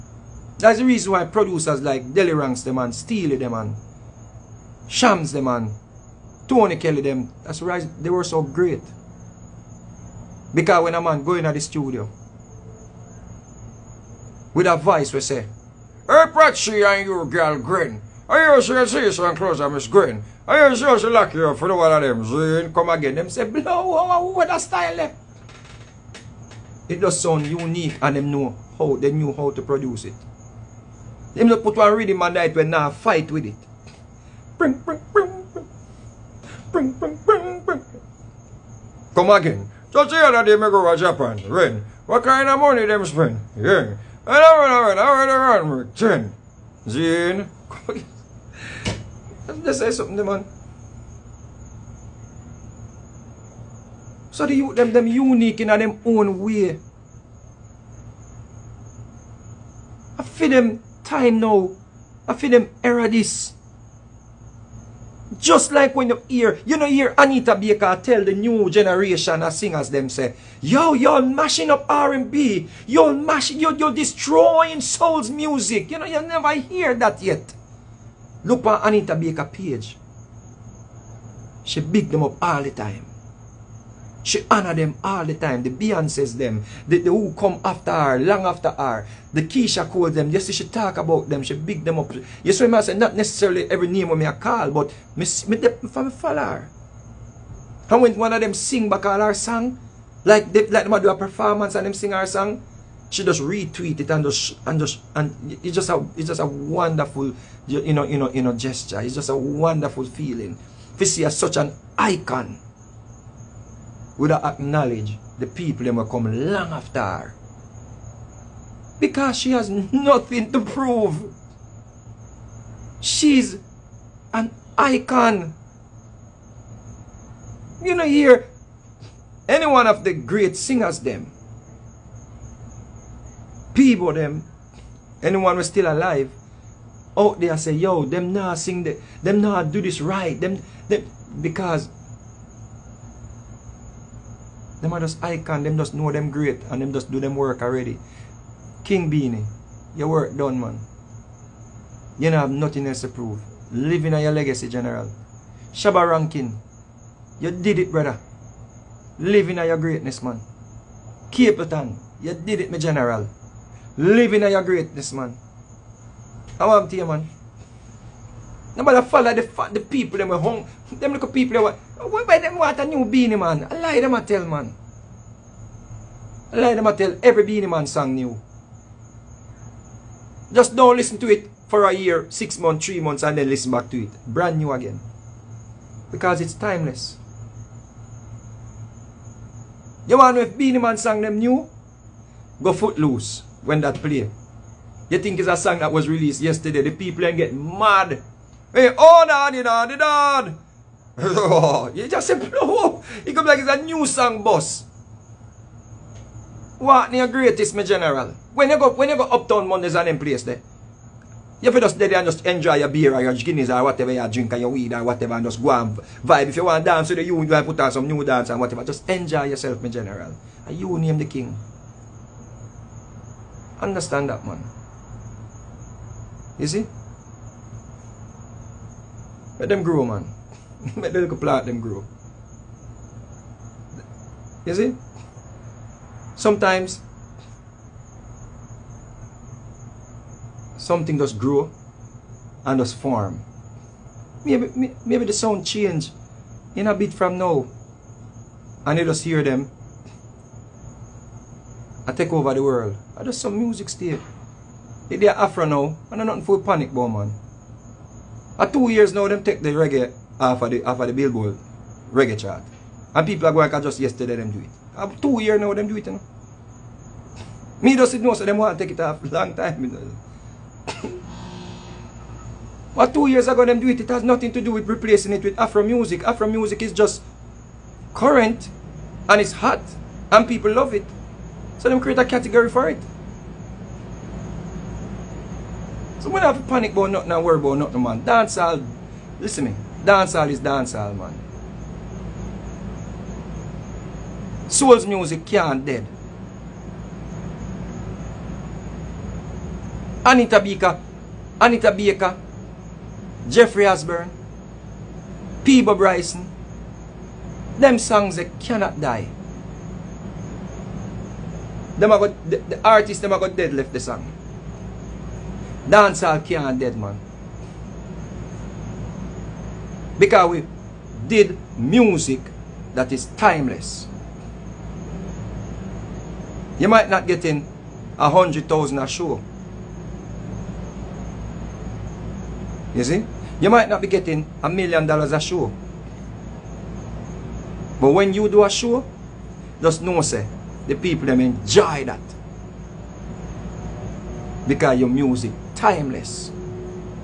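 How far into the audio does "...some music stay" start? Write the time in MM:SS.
04:13.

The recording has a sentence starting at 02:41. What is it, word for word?
Capleton, you did it, my General.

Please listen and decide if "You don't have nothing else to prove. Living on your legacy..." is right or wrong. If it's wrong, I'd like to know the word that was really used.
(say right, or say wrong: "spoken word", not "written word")
right.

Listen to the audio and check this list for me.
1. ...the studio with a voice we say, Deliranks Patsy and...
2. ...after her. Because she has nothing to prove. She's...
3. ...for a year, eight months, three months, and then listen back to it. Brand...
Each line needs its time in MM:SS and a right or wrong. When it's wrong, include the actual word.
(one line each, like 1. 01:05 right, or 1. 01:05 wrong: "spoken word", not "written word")
1. 00:11 wrong: "Hey", not "Deliranks"
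2. 01:56 right
3. 03:01 wrong: "six", not "eight".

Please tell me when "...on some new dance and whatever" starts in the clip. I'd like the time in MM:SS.
03:37.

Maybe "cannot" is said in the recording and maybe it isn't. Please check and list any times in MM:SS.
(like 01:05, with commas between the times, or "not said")
05:08.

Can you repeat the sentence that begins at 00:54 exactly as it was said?
So the, them, them unique in a them own way.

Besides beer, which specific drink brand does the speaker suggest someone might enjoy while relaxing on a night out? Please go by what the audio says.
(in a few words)
Guinness.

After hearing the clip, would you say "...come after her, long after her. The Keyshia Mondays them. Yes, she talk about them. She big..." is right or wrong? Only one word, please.
wrong.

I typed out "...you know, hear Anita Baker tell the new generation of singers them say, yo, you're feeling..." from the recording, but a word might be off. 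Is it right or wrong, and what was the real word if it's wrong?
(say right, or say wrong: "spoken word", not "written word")
wrong: "mashing", not "feeling".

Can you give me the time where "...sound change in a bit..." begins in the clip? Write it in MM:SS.
04:05.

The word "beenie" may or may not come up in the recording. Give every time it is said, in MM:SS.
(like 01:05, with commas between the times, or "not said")
02:29, 02:53, 02:57, 03:10.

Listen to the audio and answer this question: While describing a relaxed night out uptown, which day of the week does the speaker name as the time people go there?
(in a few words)
Mondays.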